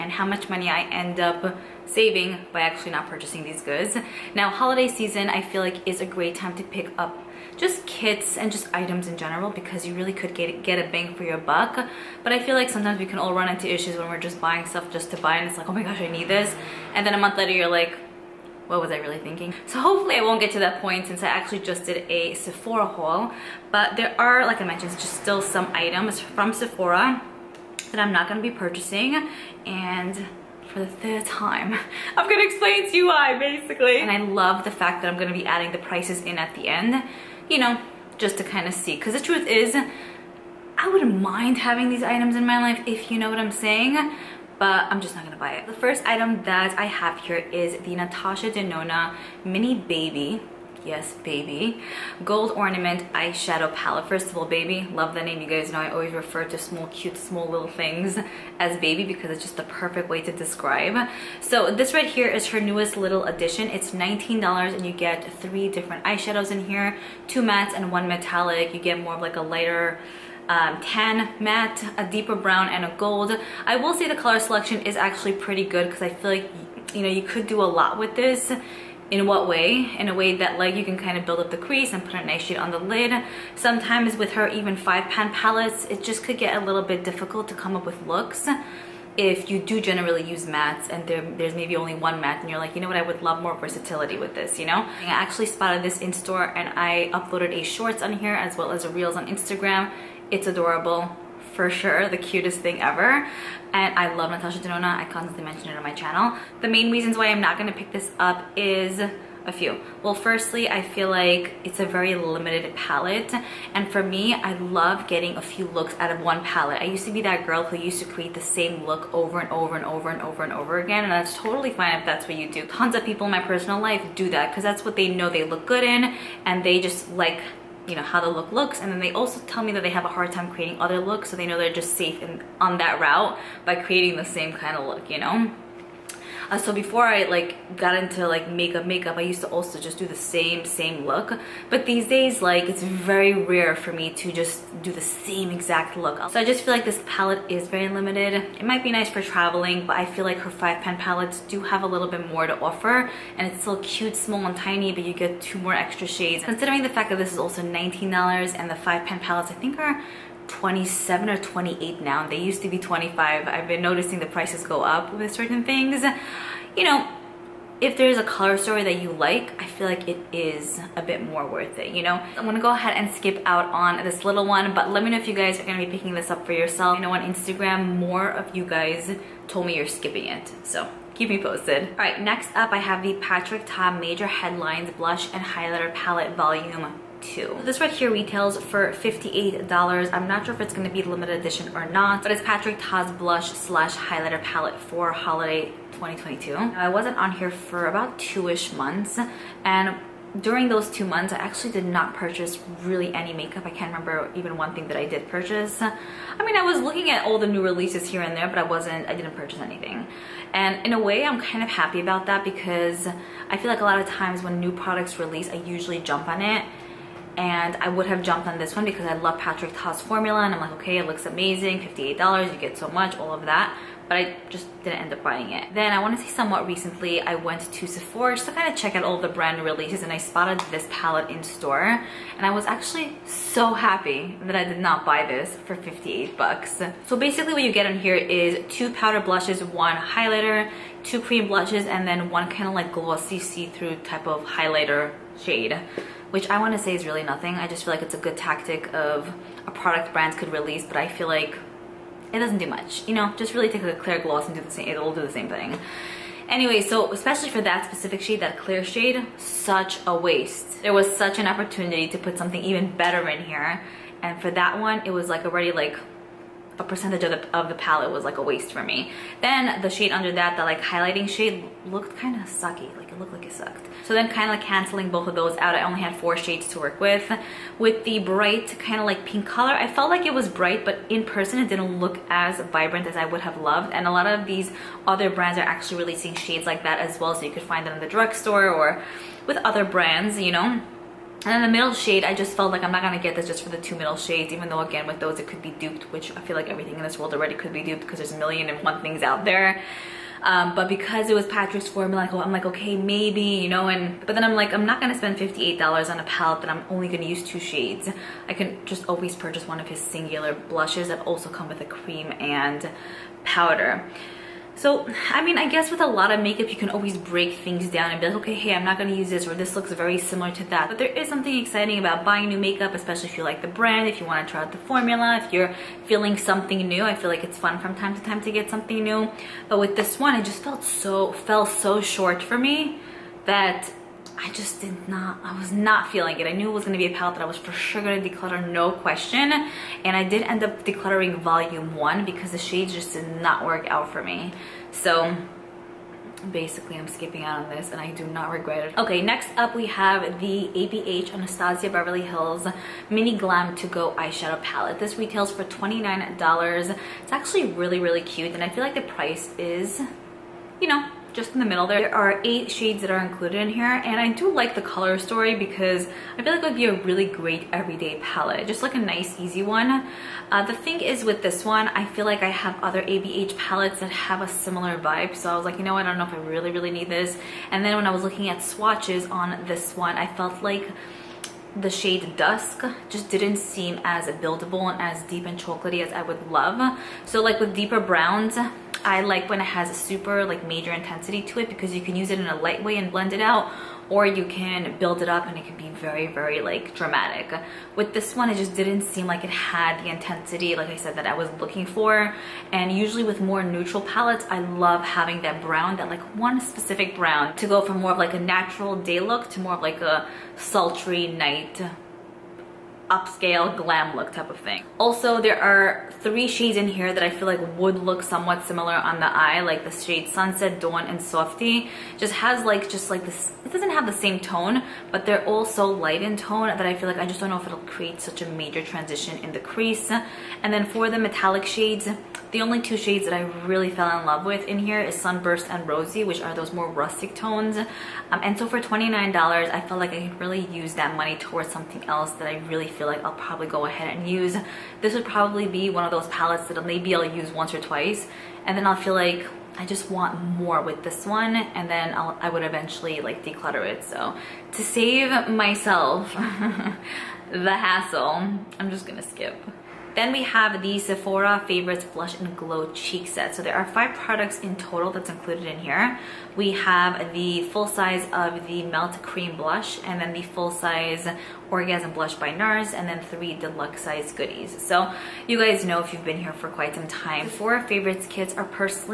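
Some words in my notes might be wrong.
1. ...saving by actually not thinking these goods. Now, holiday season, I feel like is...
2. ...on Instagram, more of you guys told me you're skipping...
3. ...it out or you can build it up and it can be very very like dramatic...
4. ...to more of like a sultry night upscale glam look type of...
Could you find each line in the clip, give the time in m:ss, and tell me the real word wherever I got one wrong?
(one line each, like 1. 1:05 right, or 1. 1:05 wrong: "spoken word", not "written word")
1. 0:01 wrong: "purchasing", not "thinking"
2. 2:57 right
3. 6:33 right
4. 6:49 right.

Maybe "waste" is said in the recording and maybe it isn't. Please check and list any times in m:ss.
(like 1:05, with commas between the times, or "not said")
4:20, 4:28.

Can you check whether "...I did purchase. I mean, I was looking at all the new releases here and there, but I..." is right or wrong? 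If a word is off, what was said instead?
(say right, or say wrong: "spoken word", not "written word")
right.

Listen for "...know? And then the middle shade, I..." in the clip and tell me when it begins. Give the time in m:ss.
4:50.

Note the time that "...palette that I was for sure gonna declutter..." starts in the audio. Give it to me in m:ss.
5:37.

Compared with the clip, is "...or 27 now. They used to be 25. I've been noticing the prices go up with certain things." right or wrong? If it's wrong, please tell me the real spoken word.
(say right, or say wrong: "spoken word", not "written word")
wrong: "28", not "27".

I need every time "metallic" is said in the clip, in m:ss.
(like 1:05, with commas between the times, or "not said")
1:08, 7:11.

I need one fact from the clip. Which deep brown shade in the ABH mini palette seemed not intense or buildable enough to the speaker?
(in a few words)
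Dusk.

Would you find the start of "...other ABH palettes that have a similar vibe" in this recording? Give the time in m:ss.
6:12.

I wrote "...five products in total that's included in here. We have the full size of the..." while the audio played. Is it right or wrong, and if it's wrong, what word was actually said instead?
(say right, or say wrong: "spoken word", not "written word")
right.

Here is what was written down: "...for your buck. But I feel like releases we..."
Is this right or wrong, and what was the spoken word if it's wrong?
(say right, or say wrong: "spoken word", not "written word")
wrong: "sometimes", not "releases".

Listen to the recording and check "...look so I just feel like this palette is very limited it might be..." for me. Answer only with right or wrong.
right.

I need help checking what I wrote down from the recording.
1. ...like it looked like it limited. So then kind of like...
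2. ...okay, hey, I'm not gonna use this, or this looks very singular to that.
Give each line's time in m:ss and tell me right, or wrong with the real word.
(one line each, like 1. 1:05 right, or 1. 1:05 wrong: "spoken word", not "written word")
1. 4:32 wrong: "sucked", not "limited"
2. 5:18 wrong: "similar", not "singular".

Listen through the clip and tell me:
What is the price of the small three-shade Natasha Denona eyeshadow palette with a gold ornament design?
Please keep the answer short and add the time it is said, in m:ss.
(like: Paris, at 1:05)
$19, at 1:03.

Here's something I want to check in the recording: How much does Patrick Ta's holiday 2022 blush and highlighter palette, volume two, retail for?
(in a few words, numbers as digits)
$58.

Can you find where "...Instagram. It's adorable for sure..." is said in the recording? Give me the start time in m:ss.
1:39.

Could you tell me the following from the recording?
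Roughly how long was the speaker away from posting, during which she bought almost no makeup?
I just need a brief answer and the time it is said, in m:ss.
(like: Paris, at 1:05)
two months, at 3:17.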